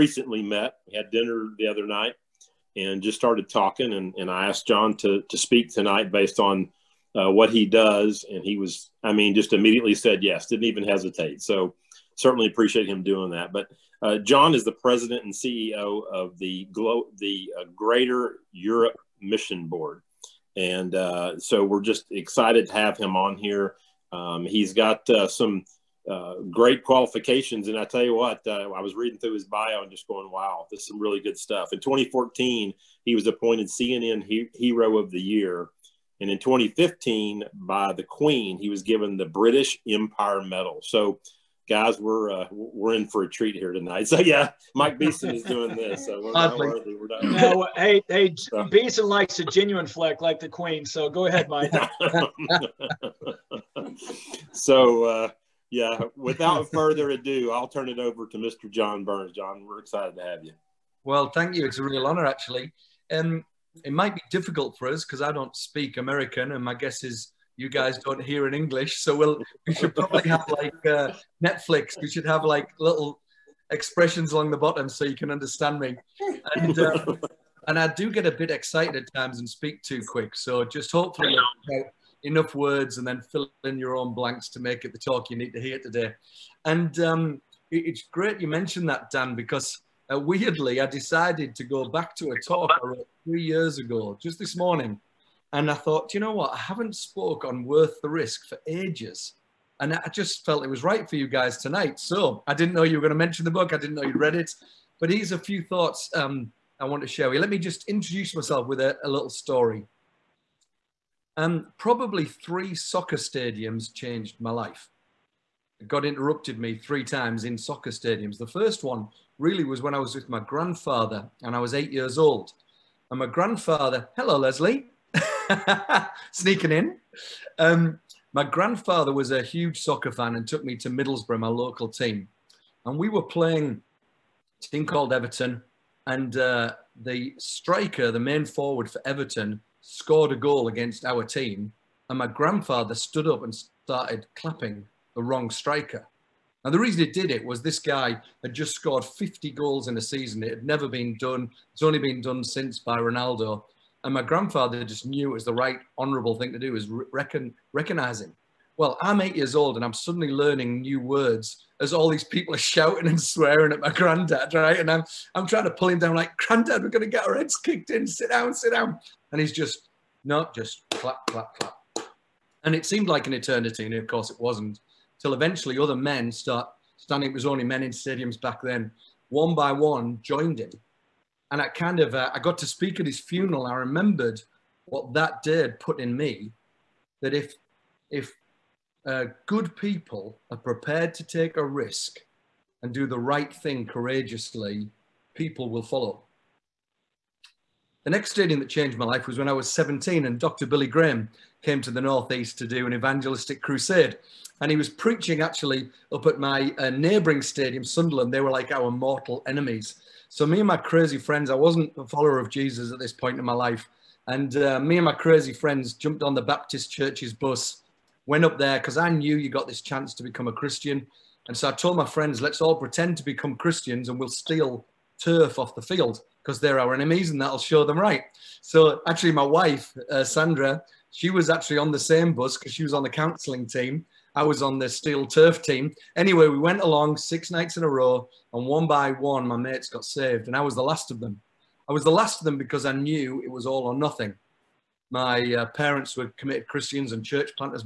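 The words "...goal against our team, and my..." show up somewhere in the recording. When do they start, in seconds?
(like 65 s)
140 s.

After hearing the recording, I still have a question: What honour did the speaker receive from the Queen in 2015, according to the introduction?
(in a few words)
British Empire Medal.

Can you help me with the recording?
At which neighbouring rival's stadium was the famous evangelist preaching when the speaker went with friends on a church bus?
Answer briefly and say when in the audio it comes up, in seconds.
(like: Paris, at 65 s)
Sunderland, at 207 s.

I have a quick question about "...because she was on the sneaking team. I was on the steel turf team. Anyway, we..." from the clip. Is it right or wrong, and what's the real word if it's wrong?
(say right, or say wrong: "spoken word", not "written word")
wrong: "counselling", not "sneaking".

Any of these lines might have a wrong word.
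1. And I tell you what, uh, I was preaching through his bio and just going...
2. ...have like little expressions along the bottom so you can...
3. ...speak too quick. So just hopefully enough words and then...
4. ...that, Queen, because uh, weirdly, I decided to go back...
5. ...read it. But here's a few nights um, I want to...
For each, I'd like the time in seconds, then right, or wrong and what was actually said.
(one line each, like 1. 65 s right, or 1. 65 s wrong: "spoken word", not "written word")
1. 27 s wrong: "reading", not "preaching"
2. 72 s right
3. 79 s right
4. 88 s wrong: "Dan", not "Queen"
5. 104 s wrong: "thoughts", not "nights".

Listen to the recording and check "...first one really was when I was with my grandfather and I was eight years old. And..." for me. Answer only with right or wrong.
right.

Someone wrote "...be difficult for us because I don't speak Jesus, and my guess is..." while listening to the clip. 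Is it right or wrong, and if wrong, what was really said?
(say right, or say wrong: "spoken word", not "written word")
wrong: "American", not "Jesus".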